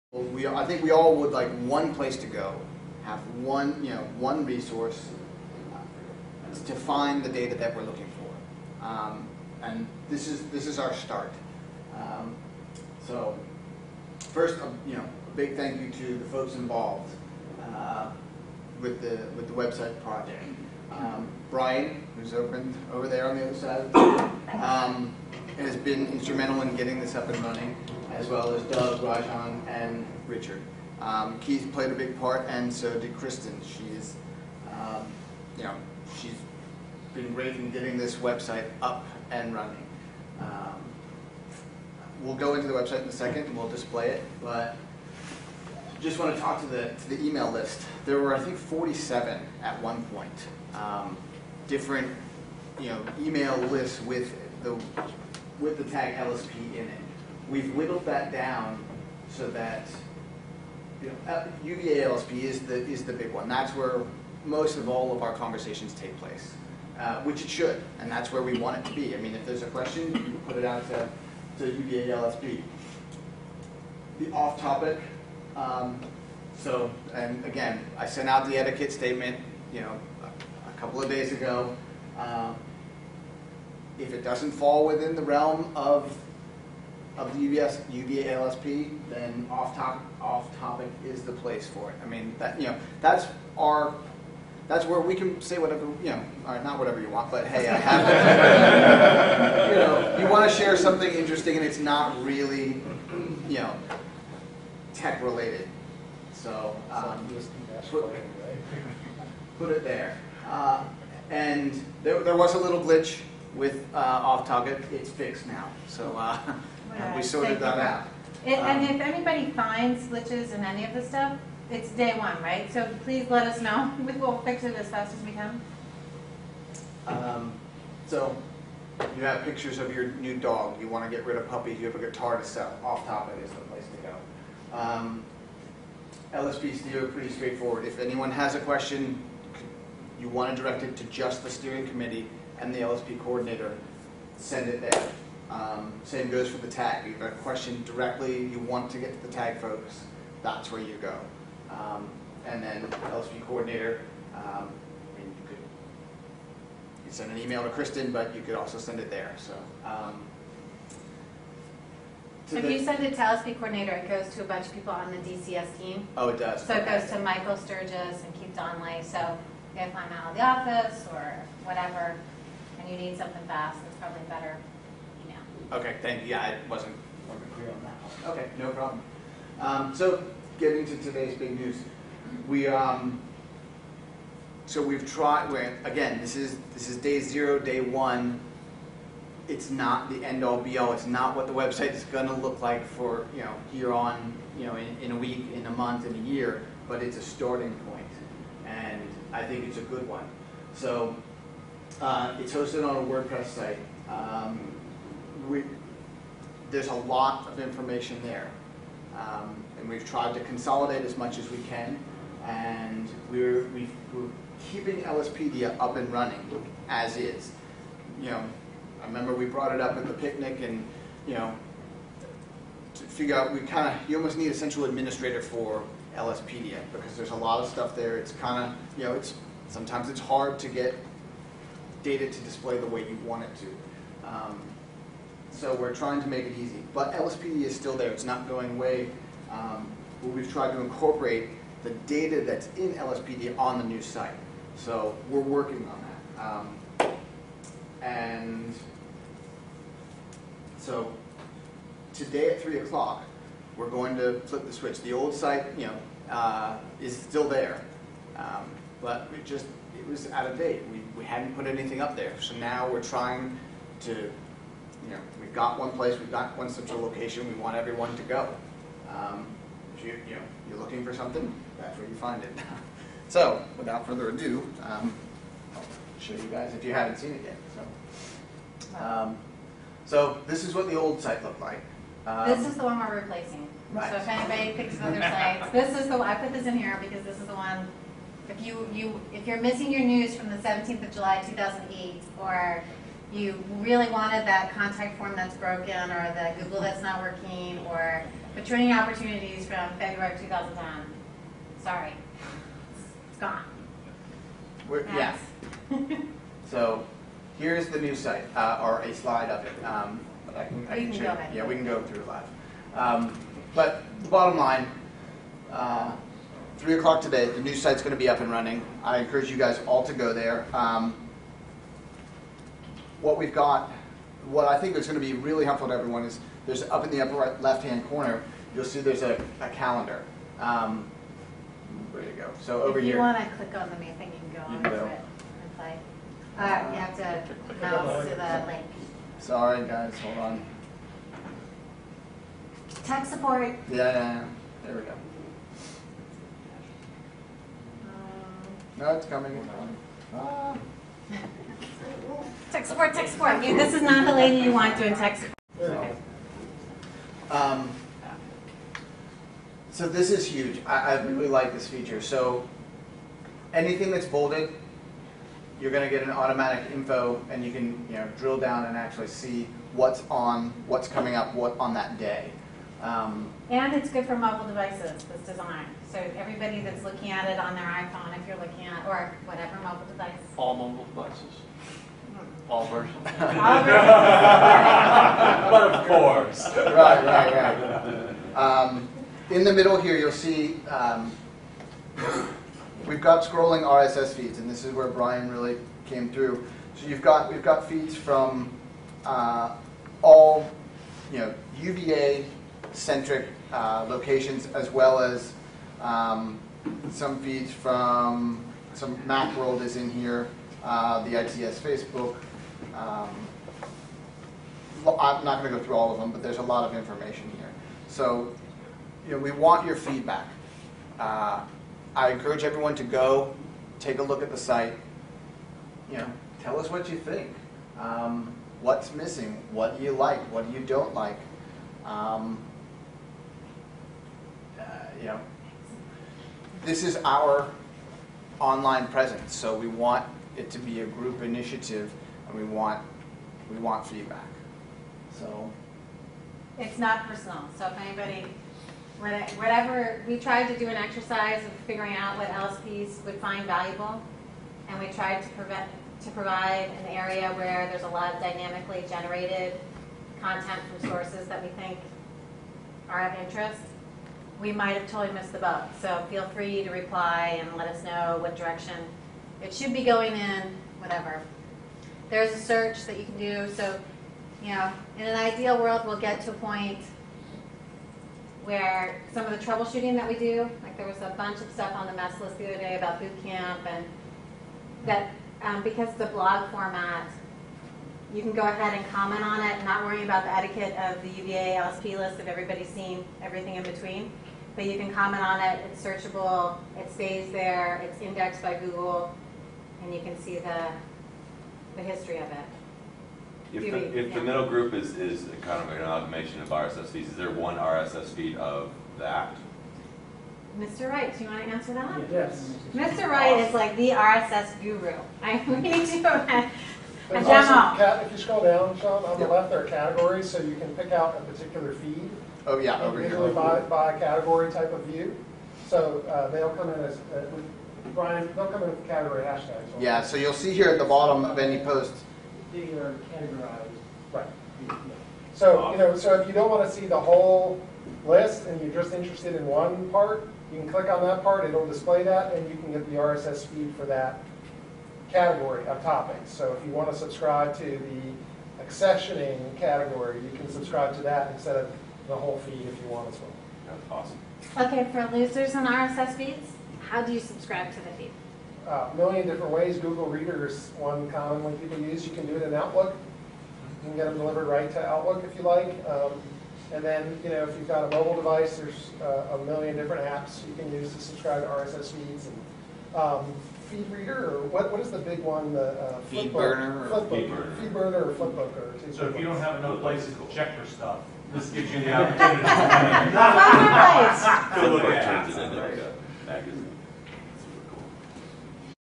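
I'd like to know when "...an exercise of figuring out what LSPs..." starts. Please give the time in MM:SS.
07:30.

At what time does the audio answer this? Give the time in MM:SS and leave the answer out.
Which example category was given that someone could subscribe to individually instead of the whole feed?
09:08.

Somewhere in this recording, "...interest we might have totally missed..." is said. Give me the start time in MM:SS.
07:43.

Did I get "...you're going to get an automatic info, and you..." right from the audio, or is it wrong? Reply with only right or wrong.
right.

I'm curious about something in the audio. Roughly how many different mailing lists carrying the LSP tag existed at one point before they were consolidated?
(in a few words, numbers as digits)
47.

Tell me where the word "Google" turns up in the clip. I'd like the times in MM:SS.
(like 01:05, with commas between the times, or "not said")
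04:56, 08:18, 09:19.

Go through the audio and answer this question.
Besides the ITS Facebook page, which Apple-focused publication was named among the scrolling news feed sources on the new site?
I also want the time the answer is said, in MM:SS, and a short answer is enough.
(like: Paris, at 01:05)
MacWorld, at 06:49.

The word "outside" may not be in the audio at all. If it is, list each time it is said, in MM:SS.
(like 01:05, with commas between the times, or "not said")
not said.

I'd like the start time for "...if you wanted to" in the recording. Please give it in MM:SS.
09:12.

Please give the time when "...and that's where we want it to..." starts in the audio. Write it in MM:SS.
01:07.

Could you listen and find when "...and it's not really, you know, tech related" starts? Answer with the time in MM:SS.
01:41.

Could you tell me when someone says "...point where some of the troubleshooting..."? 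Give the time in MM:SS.
07:56.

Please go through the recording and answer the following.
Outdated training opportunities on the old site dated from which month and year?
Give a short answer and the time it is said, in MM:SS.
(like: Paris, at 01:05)
February 2010, at 04:59.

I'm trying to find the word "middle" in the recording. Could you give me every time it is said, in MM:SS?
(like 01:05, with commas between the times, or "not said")
06:29, 08:24.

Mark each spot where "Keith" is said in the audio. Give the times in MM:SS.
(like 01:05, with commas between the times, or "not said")
00:31, 02:48.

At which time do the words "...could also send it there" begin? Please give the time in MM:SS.
02:38.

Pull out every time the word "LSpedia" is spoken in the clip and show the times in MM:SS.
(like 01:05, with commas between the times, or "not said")
03:35, 03:46.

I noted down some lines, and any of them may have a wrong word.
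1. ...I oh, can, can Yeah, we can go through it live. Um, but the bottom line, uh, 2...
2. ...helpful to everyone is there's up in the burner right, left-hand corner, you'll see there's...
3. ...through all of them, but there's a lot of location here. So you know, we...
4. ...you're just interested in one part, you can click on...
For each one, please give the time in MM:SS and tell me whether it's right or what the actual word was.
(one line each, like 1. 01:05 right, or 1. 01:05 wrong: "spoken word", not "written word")
1. 05:10 wrong: "3", not "2"
2. 05:25 wrong: "upper", not "burner"
3. 06:55 wrong: "information", not "location"
4. 08:58 right.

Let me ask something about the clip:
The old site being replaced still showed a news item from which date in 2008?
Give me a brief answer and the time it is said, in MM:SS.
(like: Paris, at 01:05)
17 July 2008, at 04:50.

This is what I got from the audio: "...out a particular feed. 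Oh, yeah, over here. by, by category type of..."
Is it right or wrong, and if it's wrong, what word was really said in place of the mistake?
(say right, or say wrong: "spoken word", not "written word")
right.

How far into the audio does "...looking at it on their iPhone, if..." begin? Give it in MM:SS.
06:17.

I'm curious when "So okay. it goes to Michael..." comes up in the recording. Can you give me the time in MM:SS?
02:46.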